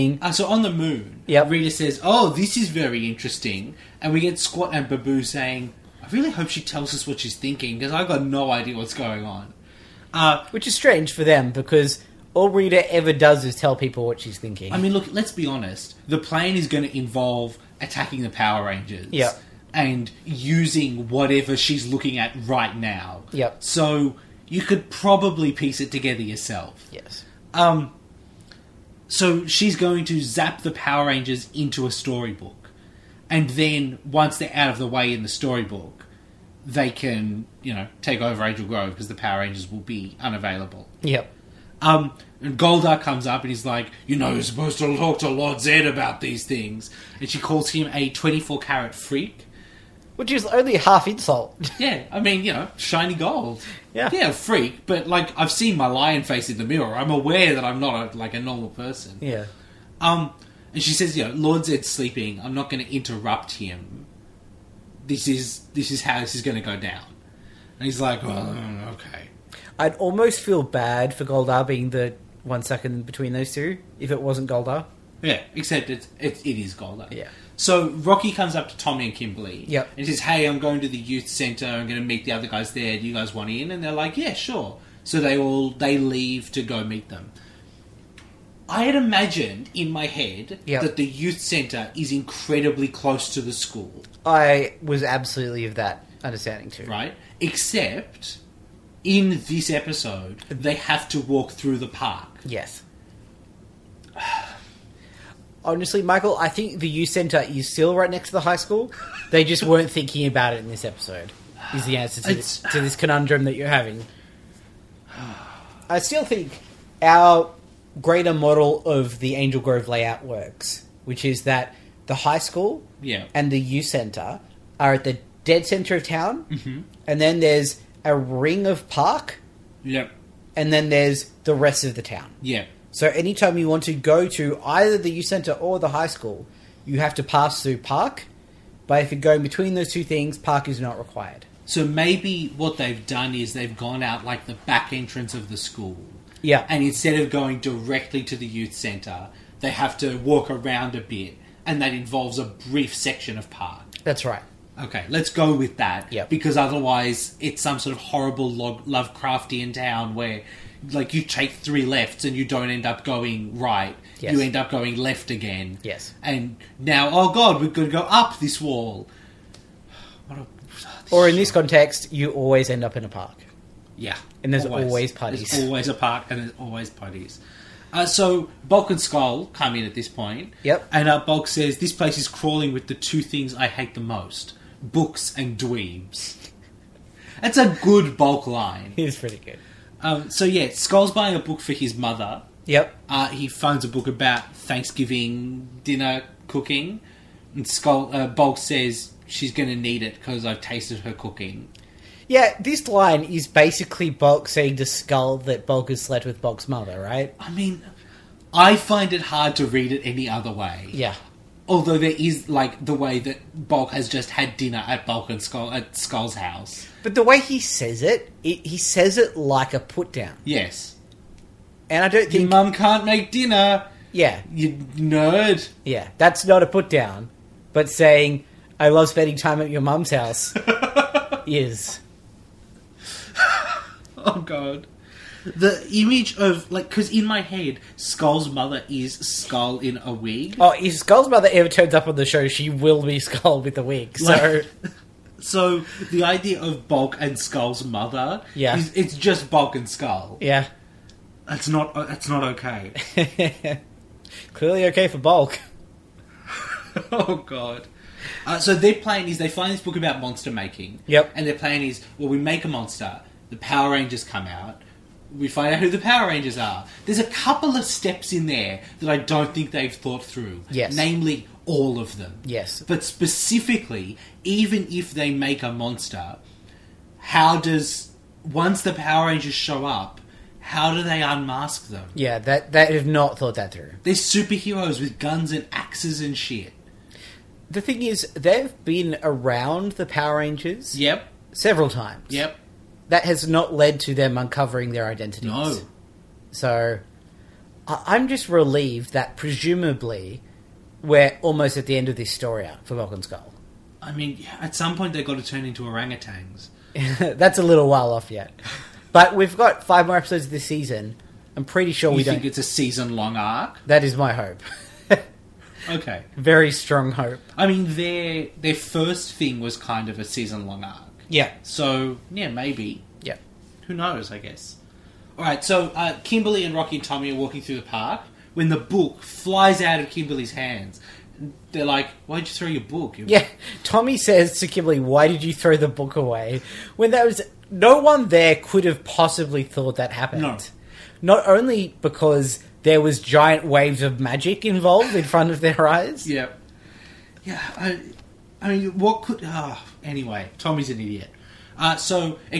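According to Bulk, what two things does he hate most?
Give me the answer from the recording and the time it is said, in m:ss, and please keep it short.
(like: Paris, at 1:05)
Books and dweebs, at 3:04.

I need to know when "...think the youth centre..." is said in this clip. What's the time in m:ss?
1:46.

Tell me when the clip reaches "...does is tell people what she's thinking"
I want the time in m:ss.
0:13.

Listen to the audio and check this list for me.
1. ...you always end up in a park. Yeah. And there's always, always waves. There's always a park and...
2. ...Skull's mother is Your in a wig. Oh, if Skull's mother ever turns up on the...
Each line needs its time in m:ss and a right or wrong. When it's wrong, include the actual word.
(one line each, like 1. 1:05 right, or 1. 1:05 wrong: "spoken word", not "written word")
1. 2:52 wrong: "parties", not "waves"
2. 3:57 wrong: "Skull", not "Your".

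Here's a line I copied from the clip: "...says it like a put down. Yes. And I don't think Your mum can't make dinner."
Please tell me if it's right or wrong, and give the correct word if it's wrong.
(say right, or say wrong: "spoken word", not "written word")
right.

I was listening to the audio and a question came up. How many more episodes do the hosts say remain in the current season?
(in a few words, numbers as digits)
5.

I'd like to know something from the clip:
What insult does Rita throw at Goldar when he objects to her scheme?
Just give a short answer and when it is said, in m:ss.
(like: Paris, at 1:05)
24 carat freak, at 0:48.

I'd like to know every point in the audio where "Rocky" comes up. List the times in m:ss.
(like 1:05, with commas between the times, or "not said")
1:17, 5:26.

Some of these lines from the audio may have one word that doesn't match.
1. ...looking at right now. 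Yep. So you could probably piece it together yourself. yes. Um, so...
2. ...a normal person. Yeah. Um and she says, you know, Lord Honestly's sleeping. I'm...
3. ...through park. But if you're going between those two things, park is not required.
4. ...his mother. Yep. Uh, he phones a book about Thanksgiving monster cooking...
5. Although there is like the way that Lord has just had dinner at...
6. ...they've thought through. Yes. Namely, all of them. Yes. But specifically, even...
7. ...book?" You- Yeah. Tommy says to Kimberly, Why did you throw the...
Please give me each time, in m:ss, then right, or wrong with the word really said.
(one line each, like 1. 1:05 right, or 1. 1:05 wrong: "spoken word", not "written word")
1. 0:21 right
2. 0:58 wrong: "Zed", not "Honestly"
3. 2:17 right
4. 3:11 wrong: "dinner", not "monster"
5. 3:31 wrong: "Bulk", not "Lord"
6. 4:29 right
7. 5:32 right.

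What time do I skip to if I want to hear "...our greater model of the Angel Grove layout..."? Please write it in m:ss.
1:57.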